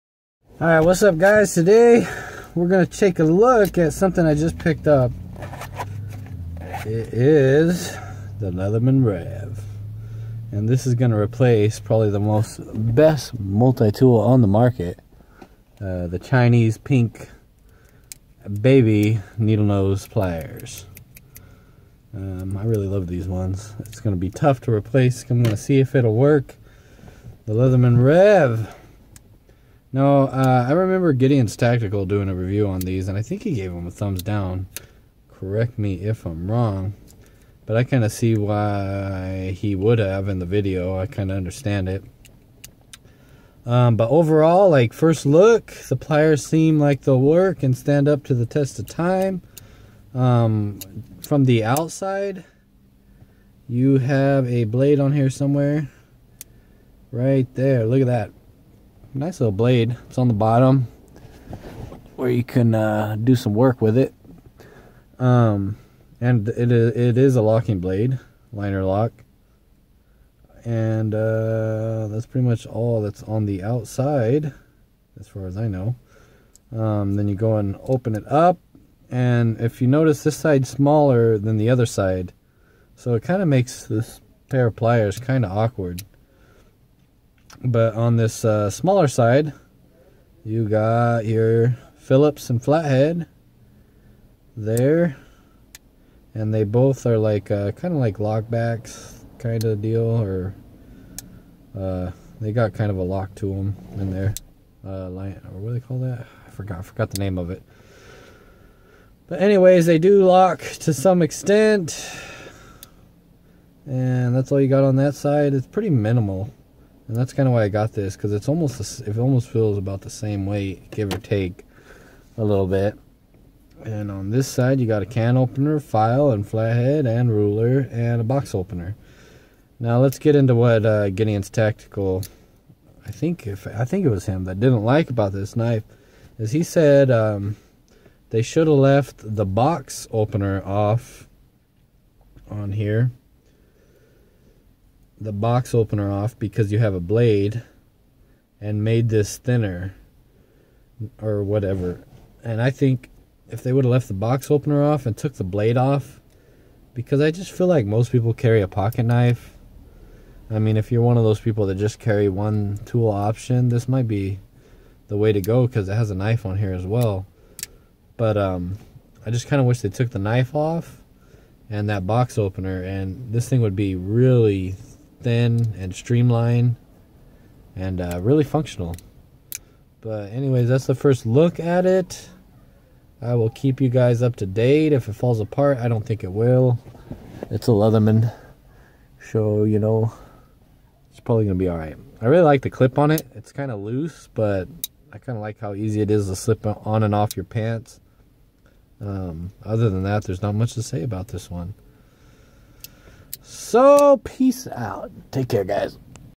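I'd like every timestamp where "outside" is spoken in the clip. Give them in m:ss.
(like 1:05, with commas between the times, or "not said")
0:51, 1:13.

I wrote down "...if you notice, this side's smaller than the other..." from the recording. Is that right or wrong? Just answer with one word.
right.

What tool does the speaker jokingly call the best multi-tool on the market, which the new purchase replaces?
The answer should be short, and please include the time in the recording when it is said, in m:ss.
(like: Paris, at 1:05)
Chinese pink baby needle nose pliers, at 0:16.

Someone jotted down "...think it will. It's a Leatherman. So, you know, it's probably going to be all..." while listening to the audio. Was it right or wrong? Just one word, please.
right.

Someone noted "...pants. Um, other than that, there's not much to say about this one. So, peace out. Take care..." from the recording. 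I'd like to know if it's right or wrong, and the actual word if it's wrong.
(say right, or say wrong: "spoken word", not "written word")
right.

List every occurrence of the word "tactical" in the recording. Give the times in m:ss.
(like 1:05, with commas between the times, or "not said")
0:31, 2:11.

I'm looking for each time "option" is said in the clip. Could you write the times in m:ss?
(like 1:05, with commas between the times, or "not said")
2:43.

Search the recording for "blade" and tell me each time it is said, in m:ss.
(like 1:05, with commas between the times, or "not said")
0:54, 0:59, 1:07, 2:26, 2:35.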